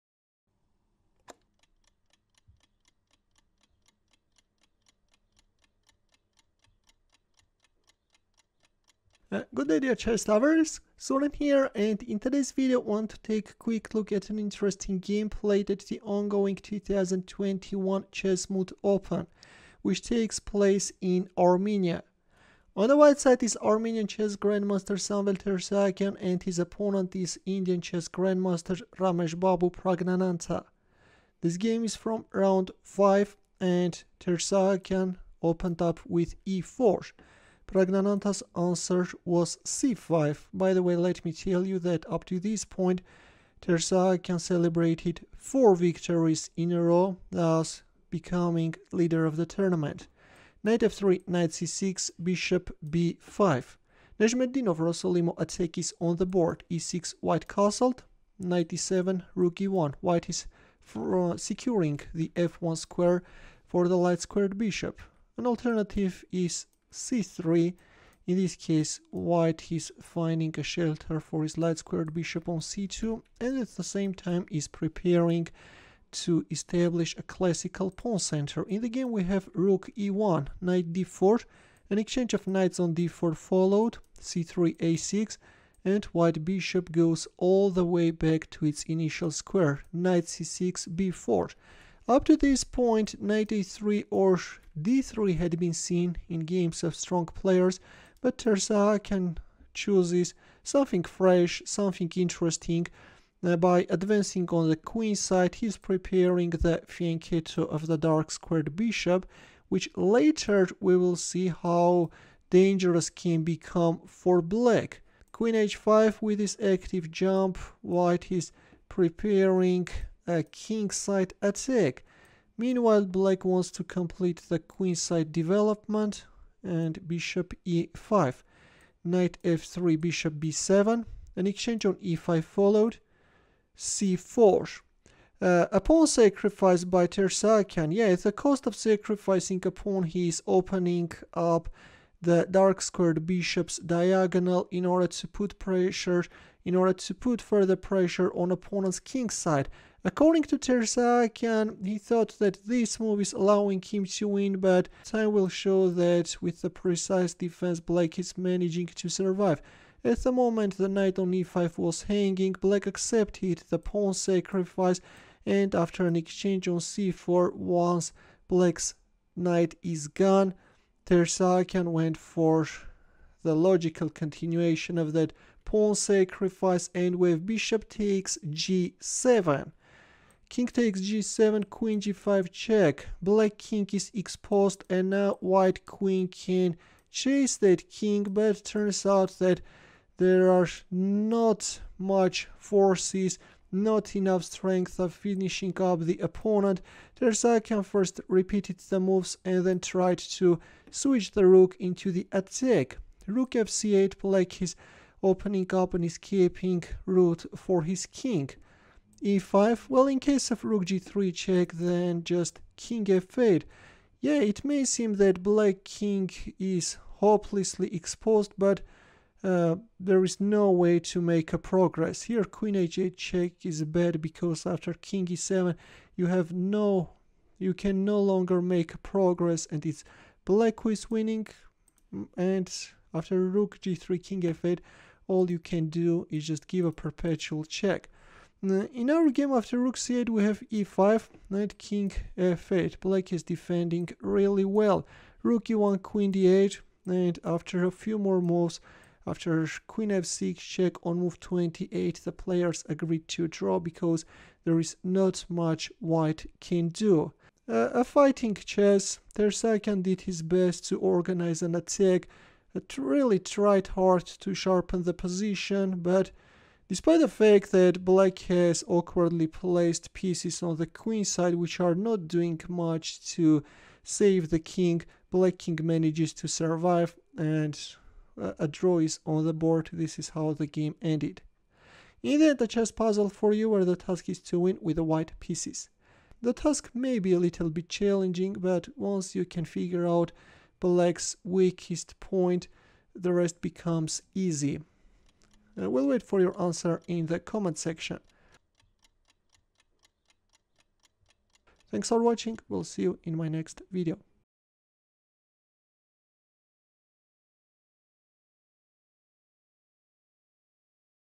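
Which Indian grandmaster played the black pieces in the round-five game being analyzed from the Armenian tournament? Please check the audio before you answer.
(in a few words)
Rameshbabu Praggnanandhaa.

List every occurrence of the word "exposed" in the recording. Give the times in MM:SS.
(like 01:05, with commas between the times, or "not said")
03:04, 03:37.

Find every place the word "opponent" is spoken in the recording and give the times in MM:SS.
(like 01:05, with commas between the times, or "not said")
00:26, 02:28, 03:16.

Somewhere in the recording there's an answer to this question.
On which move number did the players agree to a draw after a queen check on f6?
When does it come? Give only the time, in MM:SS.
04:11.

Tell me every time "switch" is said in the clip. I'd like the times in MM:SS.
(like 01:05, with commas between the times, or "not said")
03:21.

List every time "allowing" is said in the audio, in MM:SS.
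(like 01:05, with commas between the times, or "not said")
02:33.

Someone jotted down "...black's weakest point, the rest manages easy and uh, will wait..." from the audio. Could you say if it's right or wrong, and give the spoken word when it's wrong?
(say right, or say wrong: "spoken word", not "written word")
wrong: "becomes", not "manages".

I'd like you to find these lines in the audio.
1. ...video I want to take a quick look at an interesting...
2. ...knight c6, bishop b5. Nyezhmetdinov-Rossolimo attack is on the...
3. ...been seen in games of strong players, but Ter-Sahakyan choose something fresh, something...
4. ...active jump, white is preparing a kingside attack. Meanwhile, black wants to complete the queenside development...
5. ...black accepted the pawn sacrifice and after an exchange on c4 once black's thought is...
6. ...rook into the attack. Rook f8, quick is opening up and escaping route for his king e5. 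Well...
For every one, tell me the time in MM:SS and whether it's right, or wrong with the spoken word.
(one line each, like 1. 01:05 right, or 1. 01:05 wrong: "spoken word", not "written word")
1. 00:12 right
2. 00:51 right
3. 01:35 right
4. 01:56 right
5. 02:42 wrong: "knight", not "thought"
6. 03:21 wrong: "black", not "quick".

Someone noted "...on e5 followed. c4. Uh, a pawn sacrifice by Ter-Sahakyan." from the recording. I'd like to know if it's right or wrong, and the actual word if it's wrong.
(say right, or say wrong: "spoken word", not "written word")
right.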